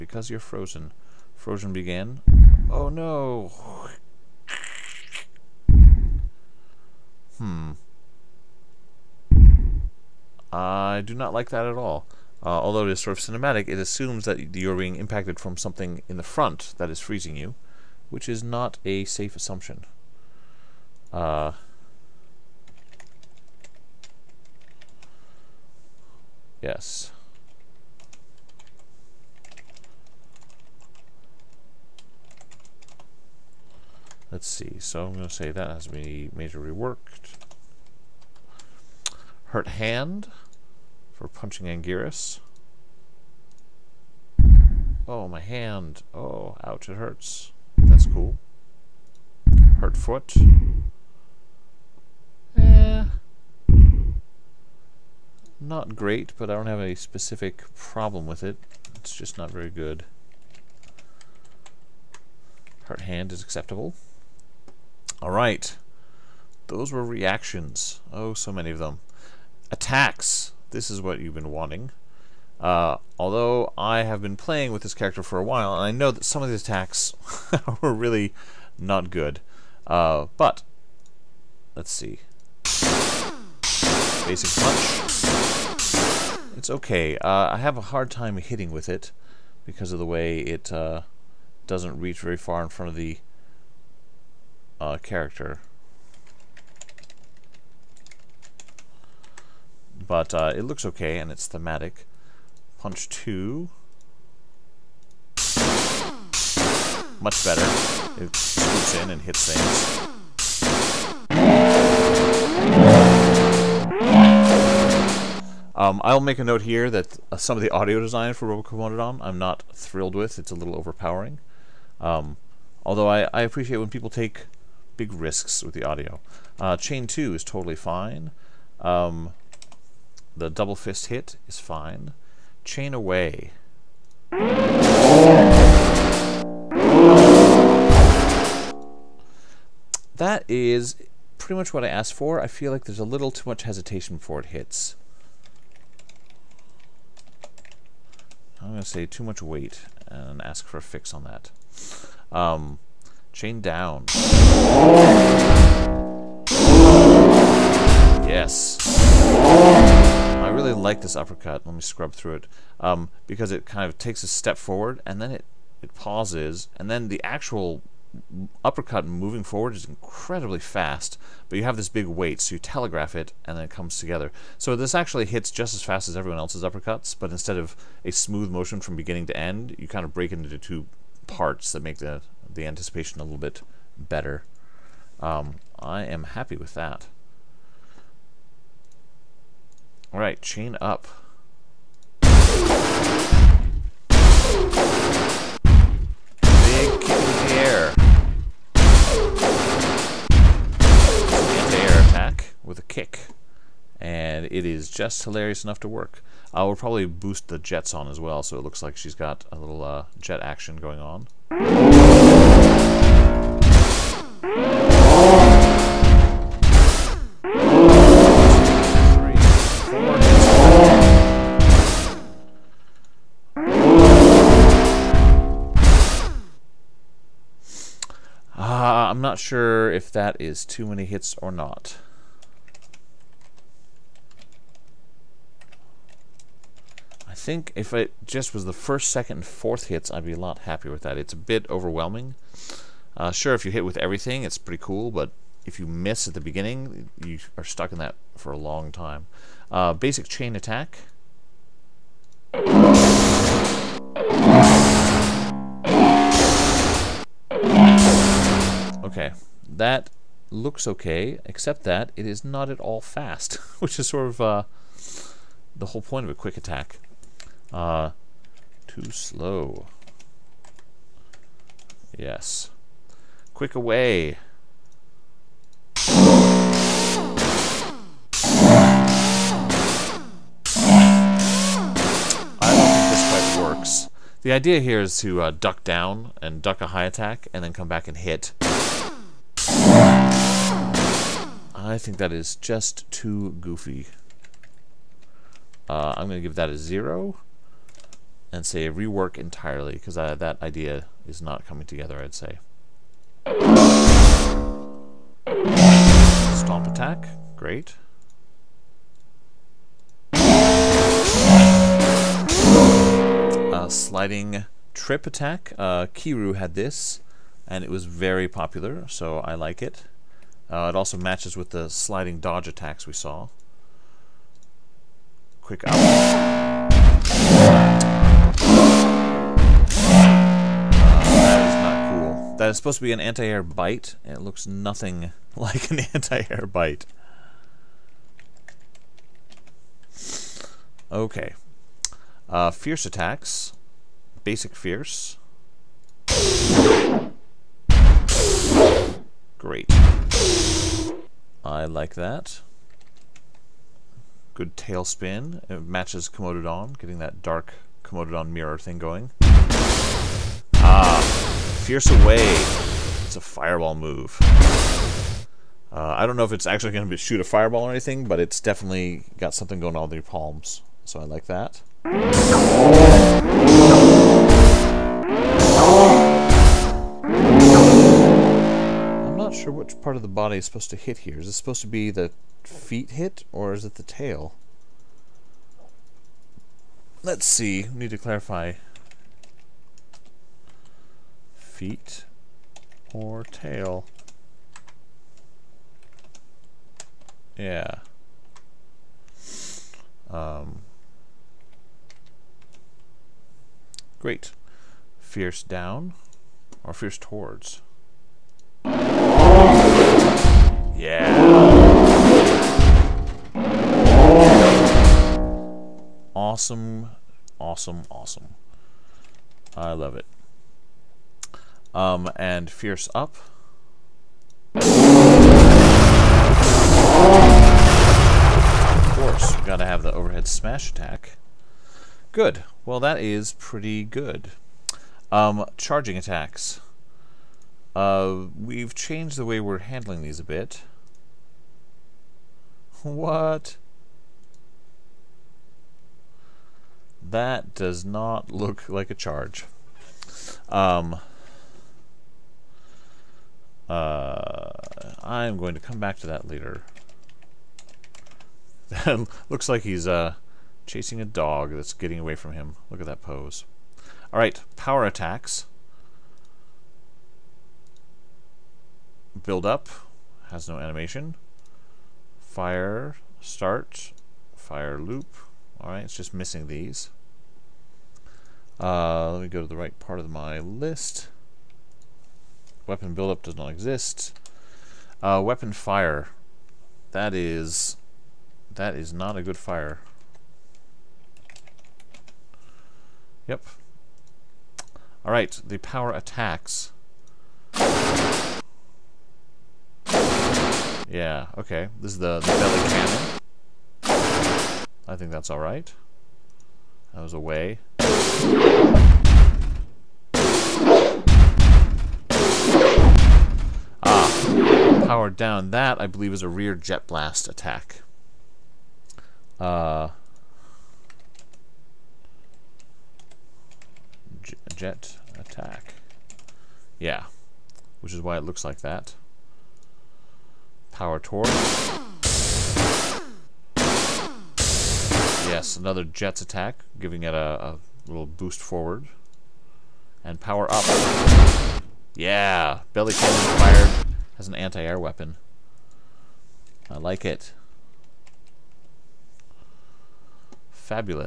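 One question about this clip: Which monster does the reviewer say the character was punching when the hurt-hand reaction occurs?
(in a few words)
Anguirus.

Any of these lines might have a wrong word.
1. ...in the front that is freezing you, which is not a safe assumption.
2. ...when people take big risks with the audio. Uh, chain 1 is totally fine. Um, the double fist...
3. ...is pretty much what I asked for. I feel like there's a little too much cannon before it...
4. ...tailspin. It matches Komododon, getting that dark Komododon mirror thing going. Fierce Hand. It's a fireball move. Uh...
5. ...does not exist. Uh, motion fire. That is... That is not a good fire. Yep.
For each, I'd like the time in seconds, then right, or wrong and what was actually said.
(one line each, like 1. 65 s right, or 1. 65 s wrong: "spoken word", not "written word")
1. 16 s right
2. 123 s wrong: "2", not "1"
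3. 140 s wrong: "hesitation", not "cannon"
4. 354 s wrong: "Away", not "Hand"
5. 483 s wrong: "weapon", not "motion".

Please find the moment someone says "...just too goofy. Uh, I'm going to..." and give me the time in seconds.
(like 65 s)
292 s.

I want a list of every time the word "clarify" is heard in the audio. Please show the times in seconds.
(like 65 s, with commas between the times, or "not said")
388 s.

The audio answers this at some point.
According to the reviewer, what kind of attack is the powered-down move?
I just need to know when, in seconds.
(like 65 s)
516 s.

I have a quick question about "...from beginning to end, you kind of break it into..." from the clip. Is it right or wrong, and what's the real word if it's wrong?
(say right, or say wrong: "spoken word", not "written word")
right.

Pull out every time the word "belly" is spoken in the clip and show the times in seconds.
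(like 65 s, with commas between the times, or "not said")
502 s, 542 s.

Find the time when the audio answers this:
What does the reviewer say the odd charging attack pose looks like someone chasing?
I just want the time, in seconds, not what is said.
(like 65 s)
461 s.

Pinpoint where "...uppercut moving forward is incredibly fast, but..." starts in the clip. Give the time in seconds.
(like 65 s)
168 s.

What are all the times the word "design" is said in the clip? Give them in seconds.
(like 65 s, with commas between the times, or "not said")
117 s.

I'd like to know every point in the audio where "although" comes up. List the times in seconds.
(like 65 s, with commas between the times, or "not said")
12 s, 73 s, 122 s.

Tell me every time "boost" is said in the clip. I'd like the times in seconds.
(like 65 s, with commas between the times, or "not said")
207 s, 538 s.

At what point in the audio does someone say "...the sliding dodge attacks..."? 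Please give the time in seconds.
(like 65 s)
321 s.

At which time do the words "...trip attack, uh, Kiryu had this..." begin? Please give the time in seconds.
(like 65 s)
314 s.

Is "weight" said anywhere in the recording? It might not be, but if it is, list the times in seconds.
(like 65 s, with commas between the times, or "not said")
149 s, 172 s.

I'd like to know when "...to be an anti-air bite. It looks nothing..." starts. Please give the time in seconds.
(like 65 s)
332 s.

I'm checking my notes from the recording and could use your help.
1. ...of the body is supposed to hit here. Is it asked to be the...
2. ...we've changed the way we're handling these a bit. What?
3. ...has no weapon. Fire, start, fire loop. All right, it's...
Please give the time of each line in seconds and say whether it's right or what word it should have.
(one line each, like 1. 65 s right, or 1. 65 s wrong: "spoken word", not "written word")
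1. 380 s wrong: "supposed", not "asked"
2. 438 s right
3. 470 s wrong: "animation", not "weapon".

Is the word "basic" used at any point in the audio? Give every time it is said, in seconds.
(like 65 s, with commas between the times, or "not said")
84 s, 249 s, 344 s.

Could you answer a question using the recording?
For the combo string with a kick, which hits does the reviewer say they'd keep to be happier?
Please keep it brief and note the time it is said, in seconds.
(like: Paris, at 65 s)
first, second, and fourth, at 238 s.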